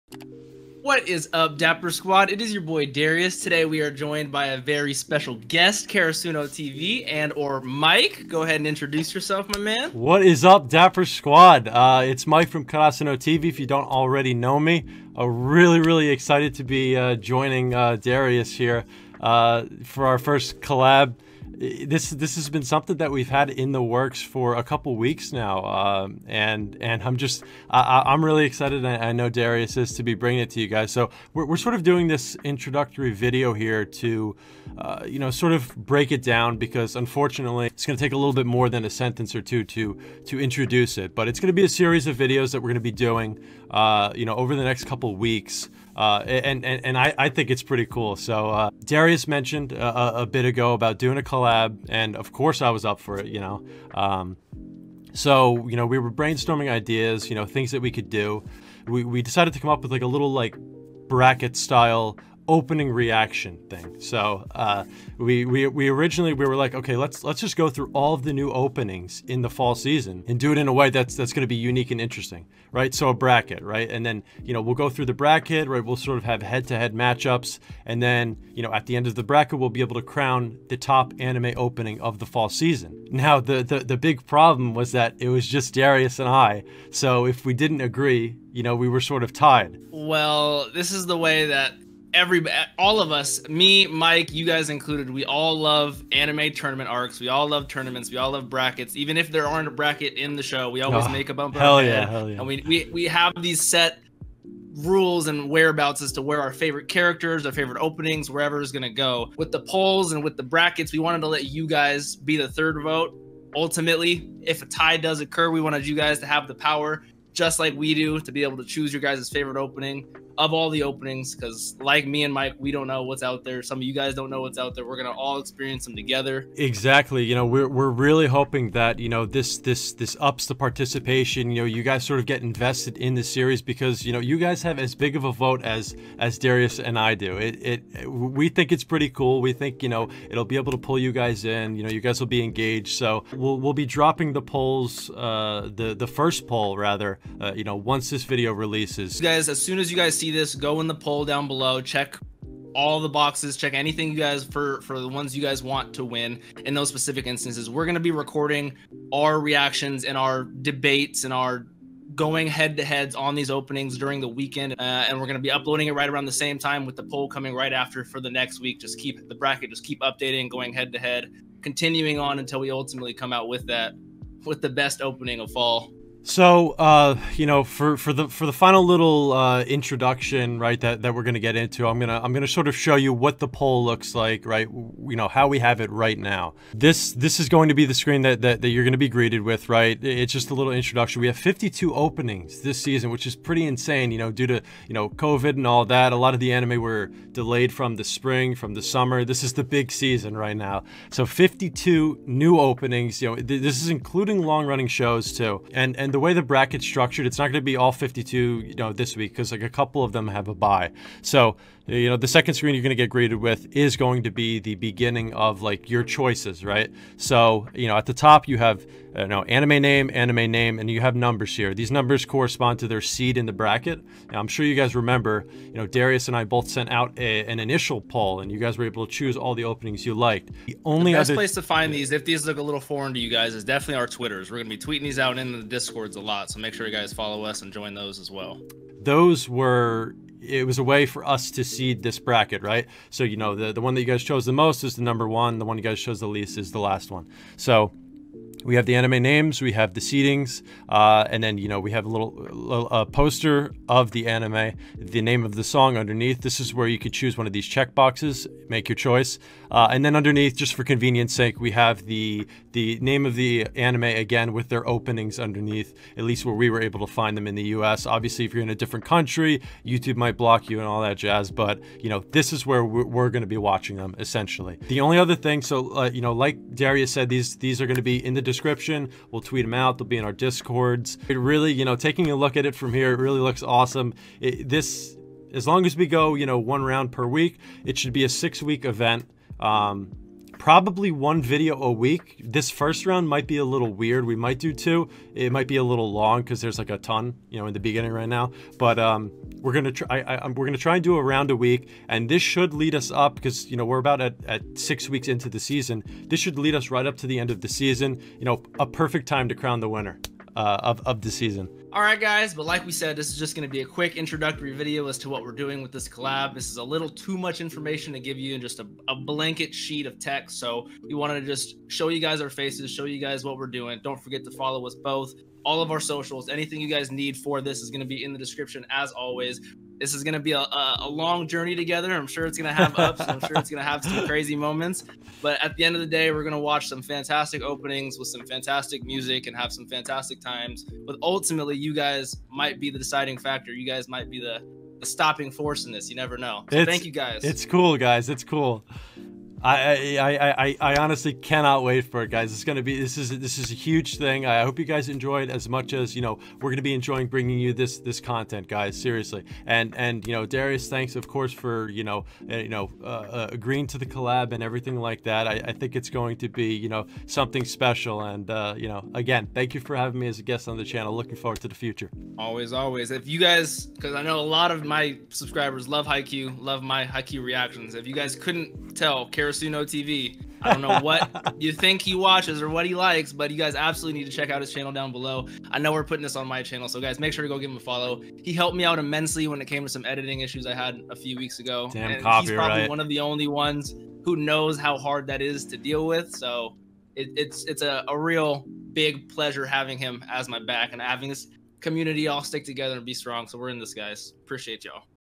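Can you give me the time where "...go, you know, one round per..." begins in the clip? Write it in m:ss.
4:46.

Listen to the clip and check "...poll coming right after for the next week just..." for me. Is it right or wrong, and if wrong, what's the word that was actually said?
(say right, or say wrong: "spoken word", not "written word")
right.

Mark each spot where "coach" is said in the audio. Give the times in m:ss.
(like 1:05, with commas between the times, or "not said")
not said.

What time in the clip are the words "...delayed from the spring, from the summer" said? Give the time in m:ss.
3:17.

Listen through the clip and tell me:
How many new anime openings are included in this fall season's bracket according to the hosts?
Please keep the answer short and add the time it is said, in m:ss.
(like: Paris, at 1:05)
52, at 3:11.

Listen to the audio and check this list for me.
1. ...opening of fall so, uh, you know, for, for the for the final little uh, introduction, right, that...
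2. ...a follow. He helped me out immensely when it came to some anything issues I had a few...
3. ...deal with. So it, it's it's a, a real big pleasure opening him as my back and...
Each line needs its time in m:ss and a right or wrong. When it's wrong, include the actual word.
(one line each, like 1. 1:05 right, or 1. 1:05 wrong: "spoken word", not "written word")
1. 2:55 right
2. 6:27 wrong: "editing", not "anything"
3. 6:35 wrong: "having", not "opening".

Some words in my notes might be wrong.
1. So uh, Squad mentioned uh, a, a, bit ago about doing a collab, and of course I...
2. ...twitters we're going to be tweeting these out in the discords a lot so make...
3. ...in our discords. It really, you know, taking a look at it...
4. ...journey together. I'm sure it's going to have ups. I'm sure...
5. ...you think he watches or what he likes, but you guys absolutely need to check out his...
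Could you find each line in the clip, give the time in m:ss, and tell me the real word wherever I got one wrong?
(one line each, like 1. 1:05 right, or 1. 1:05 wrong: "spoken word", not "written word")
1. 0:48 wrong: "Darius", not "Squad"
2. 3:54 right
3. 4:40 right
4. 5:31 right
5. 6:21 right.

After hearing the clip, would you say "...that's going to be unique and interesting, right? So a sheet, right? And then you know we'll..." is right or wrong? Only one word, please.
wrong.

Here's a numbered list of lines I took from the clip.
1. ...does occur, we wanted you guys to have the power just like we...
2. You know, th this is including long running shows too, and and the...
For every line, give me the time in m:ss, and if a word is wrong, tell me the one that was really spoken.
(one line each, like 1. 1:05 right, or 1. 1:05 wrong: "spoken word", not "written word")
1. 1:54 right
2. 3:23 right.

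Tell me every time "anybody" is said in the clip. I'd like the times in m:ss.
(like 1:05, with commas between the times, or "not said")
not said.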